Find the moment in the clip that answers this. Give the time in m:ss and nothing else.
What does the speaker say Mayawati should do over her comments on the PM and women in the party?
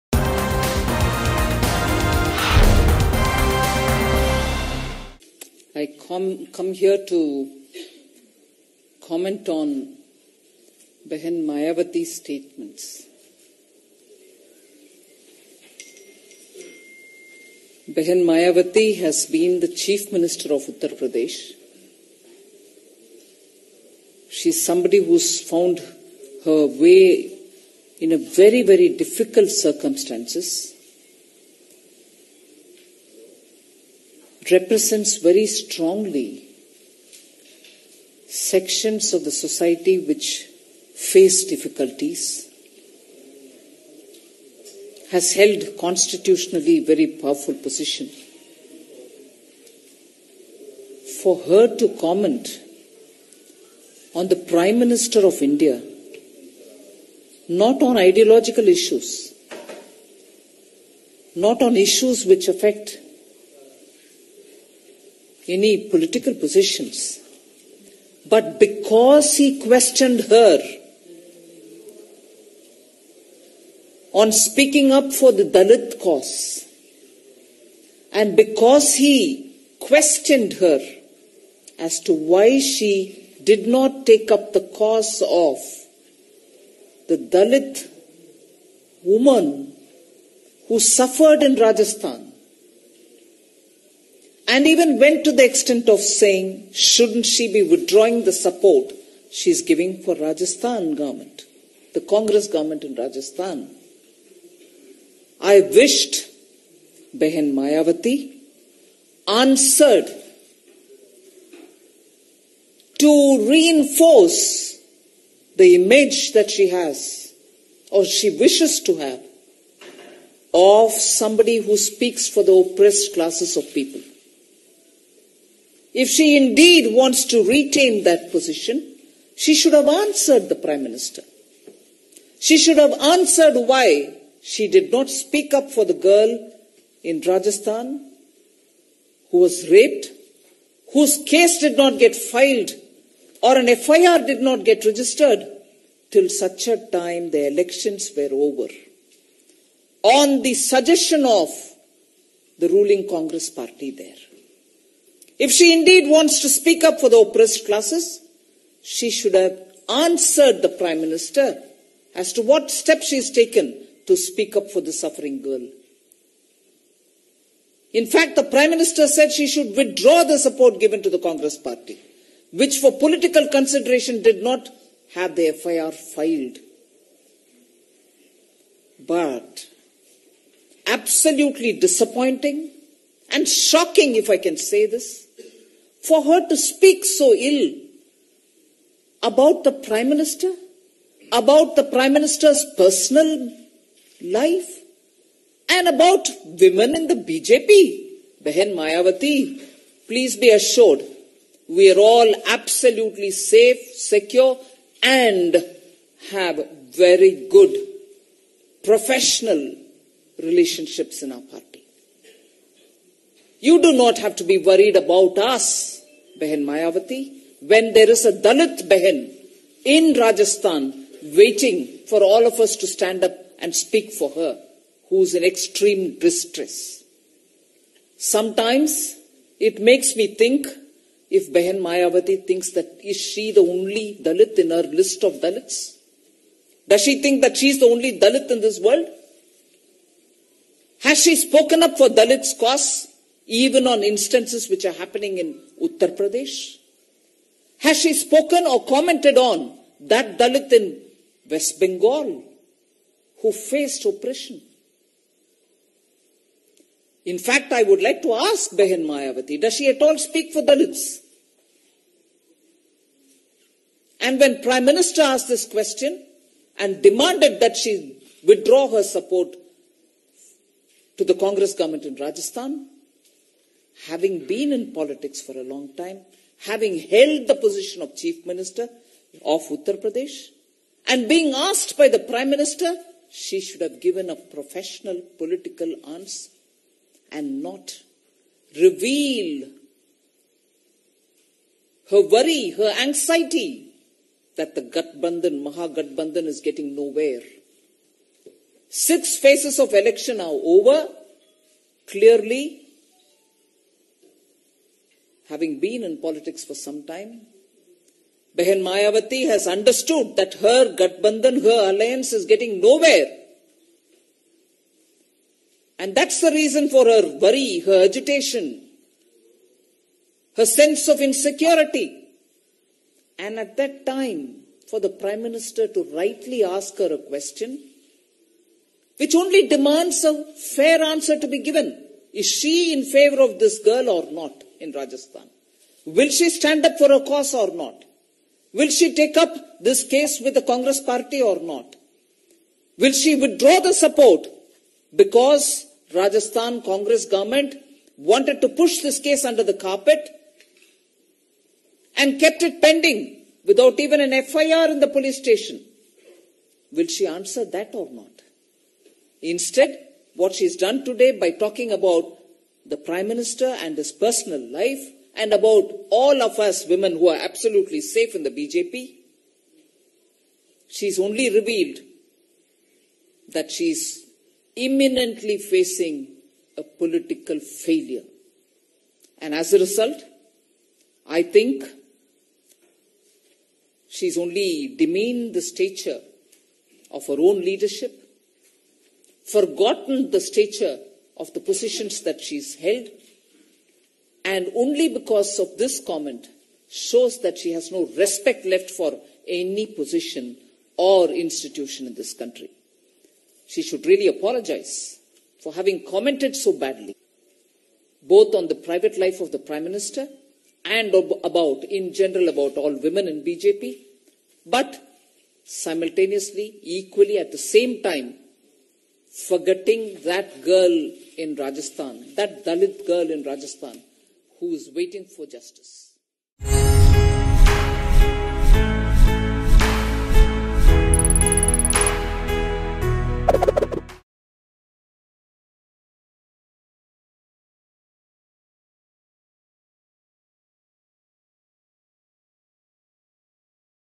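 6:44.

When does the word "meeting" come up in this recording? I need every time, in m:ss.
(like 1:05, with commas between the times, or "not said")
not said.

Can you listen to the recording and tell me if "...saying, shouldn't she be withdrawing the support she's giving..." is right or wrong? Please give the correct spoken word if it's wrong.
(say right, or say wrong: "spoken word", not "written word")
right.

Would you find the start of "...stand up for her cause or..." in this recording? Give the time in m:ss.
5:36.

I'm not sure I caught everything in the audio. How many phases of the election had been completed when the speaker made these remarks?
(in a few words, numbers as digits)
6.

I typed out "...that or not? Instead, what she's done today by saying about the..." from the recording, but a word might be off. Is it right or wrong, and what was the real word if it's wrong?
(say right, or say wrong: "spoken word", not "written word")
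wrong: "talking", not "saying".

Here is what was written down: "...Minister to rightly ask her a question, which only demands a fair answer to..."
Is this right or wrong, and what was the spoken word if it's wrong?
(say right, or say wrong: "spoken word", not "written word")
right.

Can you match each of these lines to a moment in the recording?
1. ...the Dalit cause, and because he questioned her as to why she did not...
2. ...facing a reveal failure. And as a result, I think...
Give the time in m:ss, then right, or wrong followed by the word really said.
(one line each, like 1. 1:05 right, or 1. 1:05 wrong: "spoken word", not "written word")
1. 1:15 right
2. 6:15 wrong: "political", not "reveal".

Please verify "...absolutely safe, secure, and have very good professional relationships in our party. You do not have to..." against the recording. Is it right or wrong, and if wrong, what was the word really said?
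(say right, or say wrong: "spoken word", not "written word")
right.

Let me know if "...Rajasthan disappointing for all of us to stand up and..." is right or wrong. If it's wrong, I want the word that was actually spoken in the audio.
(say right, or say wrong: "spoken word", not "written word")
wrong: "waiting", not "disappointing".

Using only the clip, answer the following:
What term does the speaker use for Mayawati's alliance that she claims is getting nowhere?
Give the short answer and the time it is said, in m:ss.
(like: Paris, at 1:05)
Mahagatbandhan, at 4:55.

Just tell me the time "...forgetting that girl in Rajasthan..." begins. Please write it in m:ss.
6:59.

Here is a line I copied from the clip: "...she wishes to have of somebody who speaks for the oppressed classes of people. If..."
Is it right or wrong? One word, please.
right.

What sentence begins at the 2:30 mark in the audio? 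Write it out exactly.
On the suggestion of the ruling Congress party there.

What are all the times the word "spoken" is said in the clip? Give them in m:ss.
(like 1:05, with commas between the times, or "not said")
4:01, 4:08.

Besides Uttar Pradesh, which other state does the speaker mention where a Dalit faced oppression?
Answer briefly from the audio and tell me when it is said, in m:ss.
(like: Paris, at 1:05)
West Bengal, at 4:11.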